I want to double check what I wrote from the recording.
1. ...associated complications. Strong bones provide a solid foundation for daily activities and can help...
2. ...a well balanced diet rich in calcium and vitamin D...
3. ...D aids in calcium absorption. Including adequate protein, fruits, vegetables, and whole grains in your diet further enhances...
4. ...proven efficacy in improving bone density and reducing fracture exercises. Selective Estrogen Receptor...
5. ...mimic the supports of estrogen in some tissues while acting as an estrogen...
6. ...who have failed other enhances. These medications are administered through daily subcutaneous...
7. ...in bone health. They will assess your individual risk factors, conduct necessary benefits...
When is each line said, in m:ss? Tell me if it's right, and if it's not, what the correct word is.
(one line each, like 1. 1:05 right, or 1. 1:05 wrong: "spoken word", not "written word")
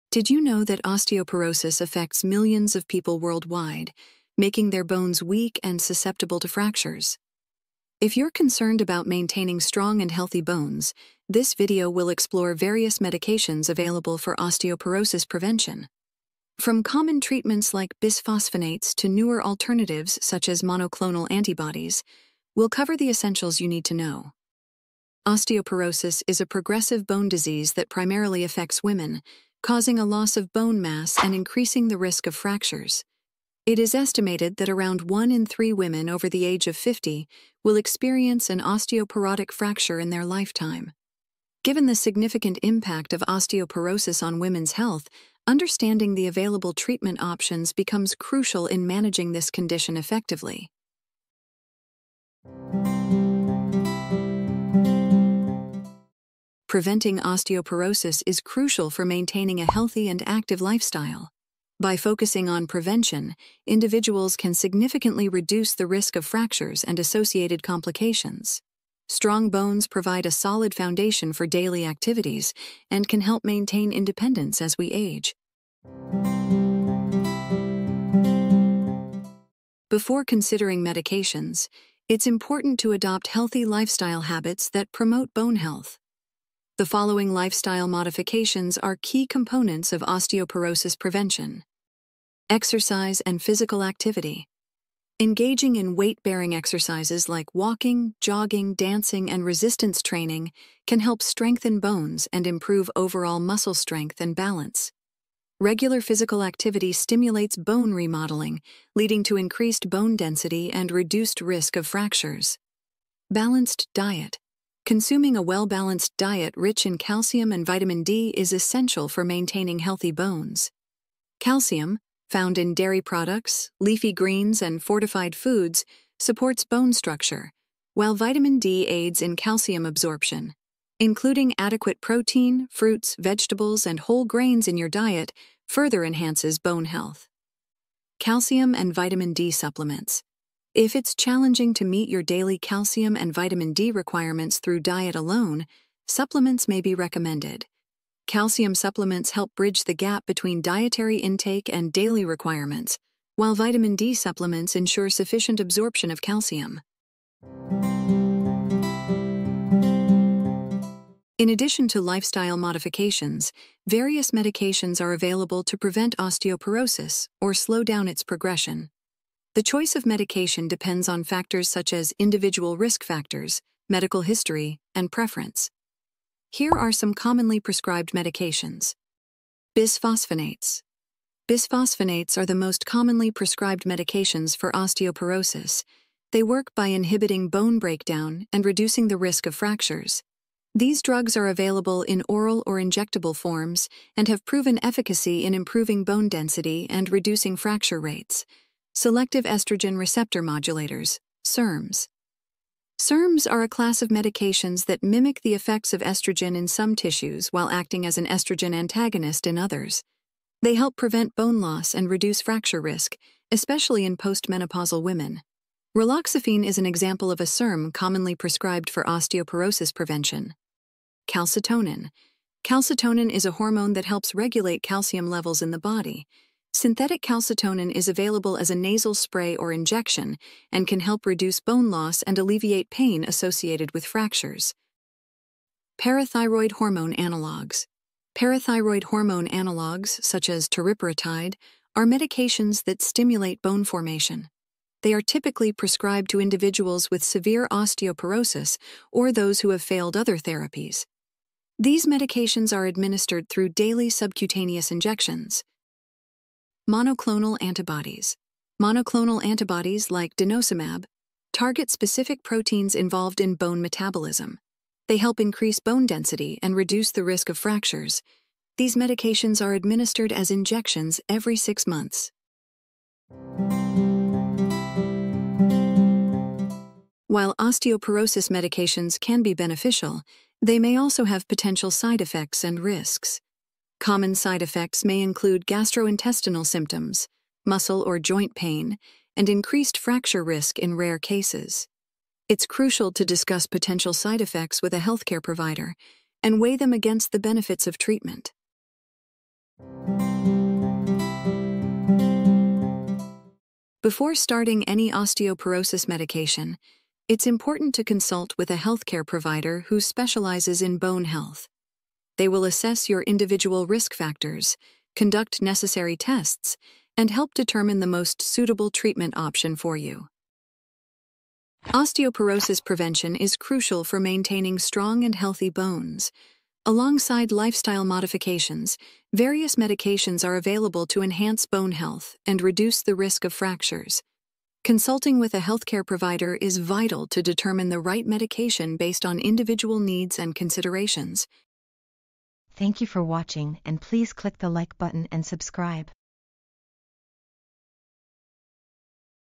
1. 1:06 right
2. 1:55 right
3. 2:08 right
4. 3:14 wrong: "rates", not "exercises"
5. 3:25 wrong: "effects", not "supports"
6. 4:09 wrong: "therapies", not "enhances"
7. 5:10 wrong: "tests", not "benefits".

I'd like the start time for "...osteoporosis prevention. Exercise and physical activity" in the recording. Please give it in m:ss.
1:30.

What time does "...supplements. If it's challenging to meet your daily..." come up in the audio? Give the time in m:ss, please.
2:19.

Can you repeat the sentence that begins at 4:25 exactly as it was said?
They help increase bone density and reduce the risk of fractures.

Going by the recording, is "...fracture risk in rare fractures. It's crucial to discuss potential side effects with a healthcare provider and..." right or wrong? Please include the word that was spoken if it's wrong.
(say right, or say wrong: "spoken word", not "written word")
wrong: "cases", not "fractures".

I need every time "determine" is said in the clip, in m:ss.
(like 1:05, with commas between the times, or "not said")
5:17, 5:37.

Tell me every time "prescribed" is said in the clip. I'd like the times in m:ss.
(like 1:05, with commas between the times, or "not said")
2:57, 3:03, 3:38, 4:05.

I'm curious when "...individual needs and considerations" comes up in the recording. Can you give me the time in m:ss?
5:39.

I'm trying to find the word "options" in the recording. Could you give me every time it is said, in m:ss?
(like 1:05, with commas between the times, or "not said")
0:47, 5:19.